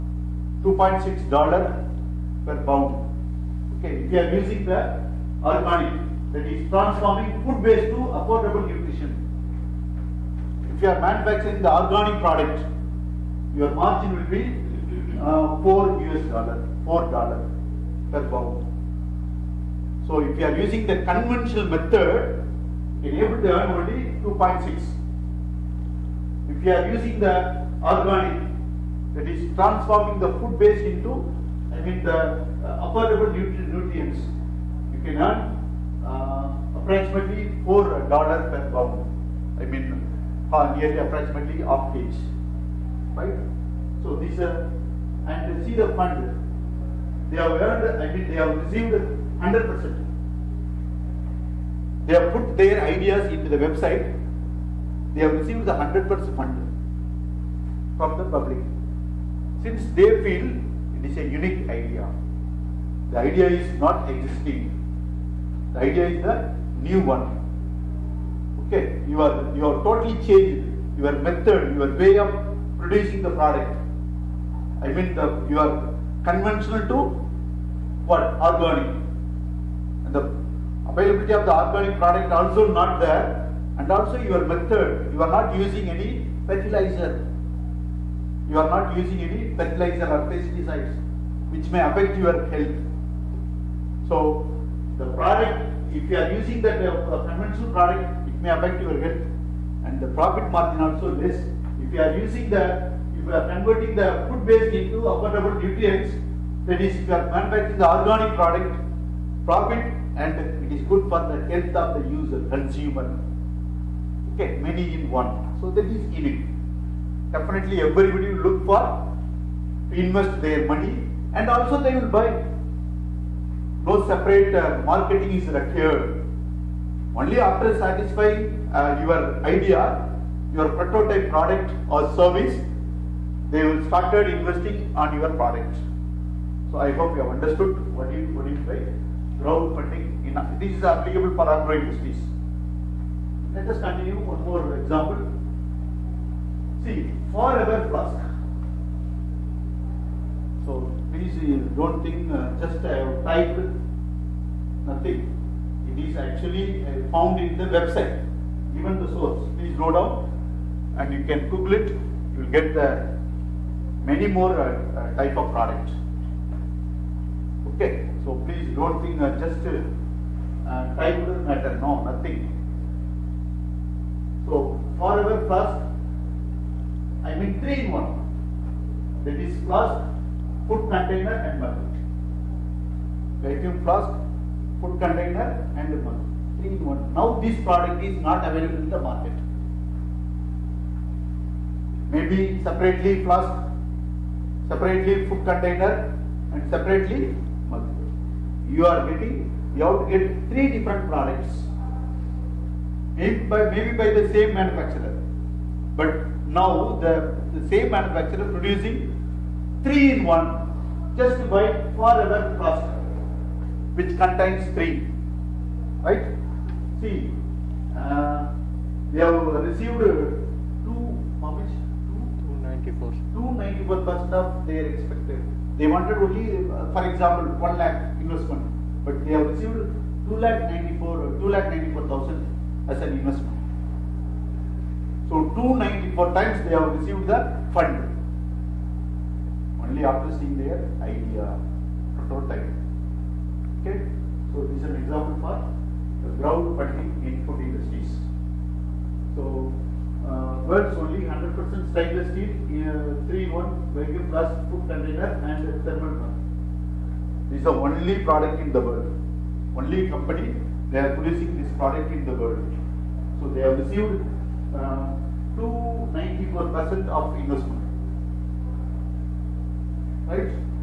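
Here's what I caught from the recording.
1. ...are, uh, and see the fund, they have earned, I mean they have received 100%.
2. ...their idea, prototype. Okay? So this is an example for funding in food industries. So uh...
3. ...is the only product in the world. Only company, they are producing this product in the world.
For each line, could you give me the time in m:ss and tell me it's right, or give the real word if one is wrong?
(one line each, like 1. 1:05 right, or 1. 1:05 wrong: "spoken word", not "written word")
1. 0:44 right
2. 4:00 right
3. 4:17 right.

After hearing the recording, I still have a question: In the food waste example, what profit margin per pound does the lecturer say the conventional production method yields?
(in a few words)
$2.6 per pound.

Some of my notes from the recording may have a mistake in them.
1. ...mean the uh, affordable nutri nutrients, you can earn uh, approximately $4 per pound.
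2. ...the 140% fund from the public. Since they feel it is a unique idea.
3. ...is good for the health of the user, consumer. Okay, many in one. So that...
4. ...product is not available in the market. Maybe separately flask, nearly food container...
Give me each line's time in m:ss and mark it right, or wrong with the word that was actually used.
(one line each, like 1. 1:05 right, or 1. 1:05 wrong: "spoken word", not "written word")
1. 0:31 right
2. 0:55 wrong: "100", not "140"
3. 1:50 right
4. 3:07 wrong: "separately", not "nearly".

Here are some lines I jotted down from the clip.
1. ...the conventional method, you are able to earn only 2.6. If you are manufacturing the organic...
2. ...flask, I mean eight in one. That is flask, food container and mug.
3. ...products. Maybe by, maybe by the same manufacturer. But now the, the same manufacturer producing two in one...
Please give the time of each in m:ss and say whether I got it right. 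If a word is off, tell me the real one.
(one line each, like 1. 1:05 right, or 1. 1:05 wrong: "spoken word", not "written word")
1. 0:20 wrong: "using", not "manufacturing"
2. 2:55 wrong: "three", not "eight"
3. 3:21 wrong: "three", not "two".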